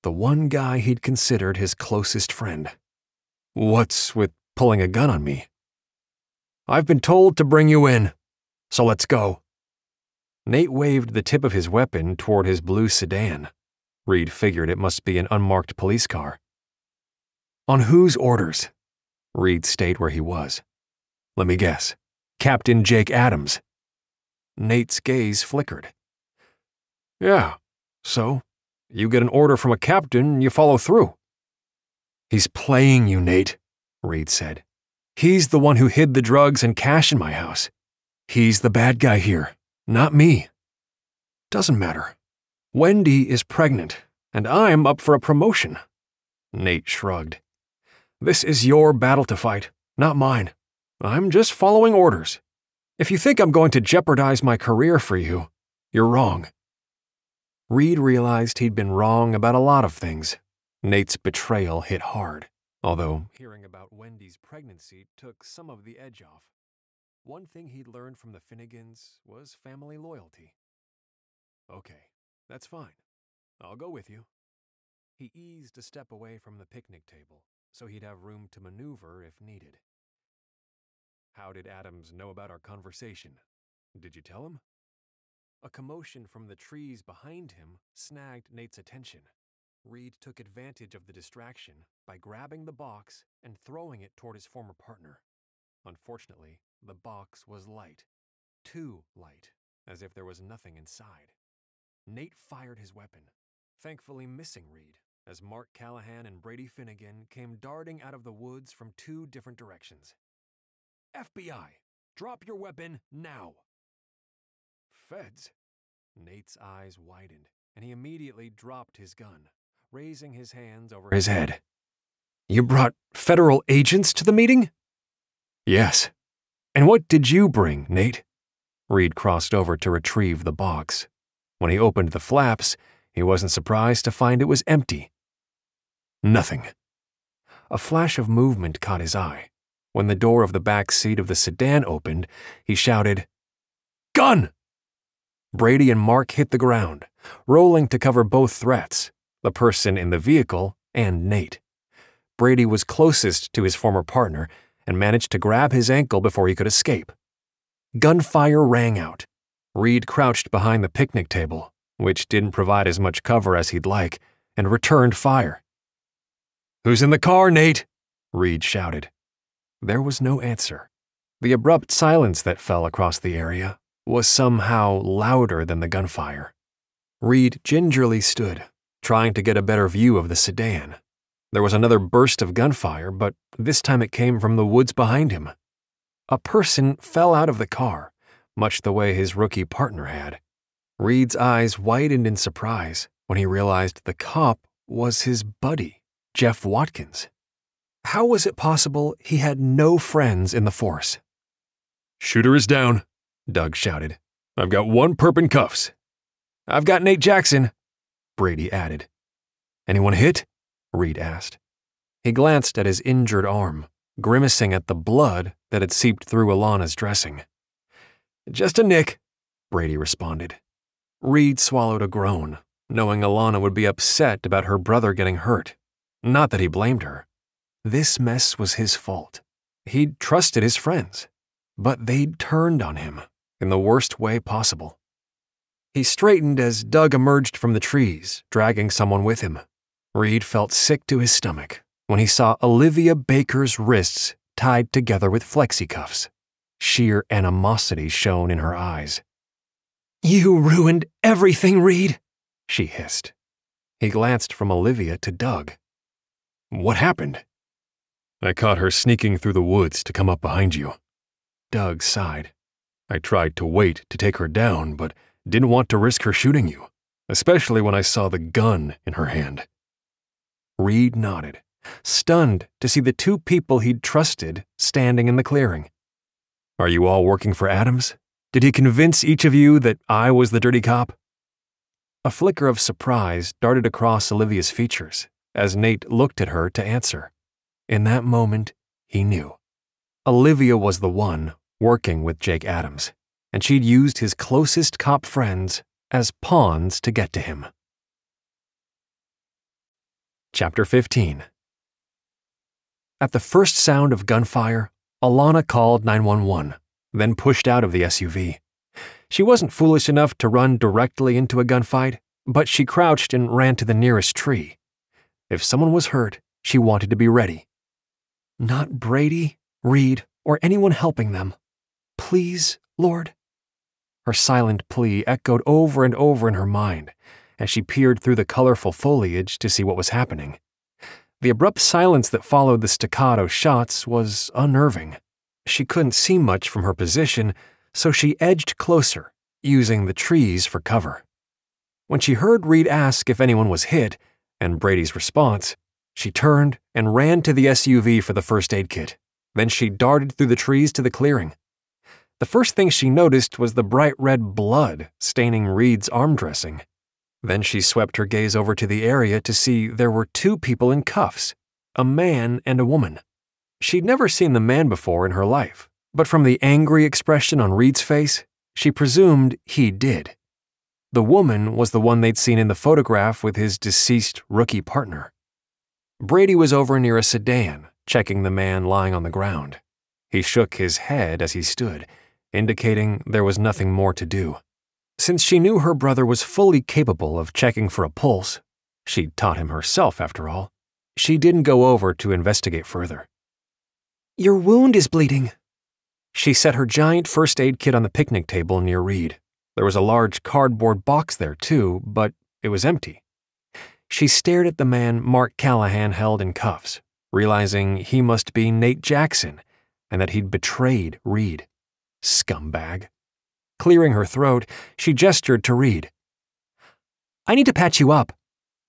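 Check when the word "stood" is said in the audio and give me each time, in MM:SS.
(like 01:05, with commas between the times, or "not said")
02:58, 06:21.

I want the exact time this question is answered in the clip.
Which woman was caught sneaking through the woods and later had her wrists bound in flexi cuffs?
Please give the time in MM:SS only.
04:02.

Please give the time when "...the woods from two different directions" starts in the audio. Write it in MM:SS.
01:48.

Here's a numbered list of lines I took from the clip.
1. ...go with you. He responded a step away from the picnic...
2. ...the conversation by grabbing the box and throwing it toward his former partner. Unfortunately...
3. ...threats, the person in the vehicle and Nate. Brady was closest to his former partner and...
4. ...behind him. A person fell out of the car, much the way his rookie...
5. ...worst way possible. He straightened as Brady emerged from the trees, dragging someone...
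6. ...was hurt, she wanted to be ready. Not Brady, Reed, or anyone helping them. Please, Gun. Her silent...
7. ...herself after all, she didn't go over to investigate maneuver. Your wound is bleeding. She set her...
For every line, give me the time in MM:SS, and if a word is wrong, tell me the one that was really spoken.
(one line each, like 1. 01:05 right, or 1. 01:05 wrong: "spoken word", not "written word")
1. 01:13 wrong: "eased", not "responded"
2. 01:31 wrong: "distraction", not "conversation"
3. 02:28 right
4. 03:04 right
5. 03:53 wrong: "Doug", not "Brady"
6. 05:15 wrong: "Lord", not "Gun"
7. 06:29 wrong: "further", not "maneuver".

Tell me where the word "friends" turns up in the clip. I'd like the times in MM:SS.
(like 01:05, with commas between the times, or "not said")
00:02, 03:19, 03:50, 04:55.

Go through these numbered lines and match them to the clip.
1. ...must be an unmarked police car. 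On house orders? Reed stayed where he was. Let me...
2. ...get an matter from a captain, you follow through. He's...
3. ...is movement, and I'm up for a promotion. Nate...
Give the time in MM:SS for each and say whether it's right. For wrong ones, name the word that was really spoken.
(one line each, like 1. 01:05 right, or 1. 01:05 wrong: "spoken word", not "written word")
1. 00:14 wrong: "whose", not "house"
2. 00:29 wrong: "order", not "matter"
3. 00:43 wrong: "pregnant", not "movement".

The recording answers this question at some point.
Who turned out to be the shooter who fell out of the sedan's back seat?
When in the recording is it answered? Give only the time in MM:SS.
03:16.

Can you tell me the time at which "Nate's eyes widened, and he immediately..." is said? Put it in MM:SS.
01:56.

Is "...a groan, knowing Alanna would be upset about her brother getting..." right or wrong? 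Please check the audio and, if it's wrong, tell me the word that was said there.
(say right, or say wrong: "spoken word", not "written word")
right.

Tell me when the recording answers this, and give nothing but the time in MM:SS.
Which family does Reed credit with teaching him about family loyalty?
01:08.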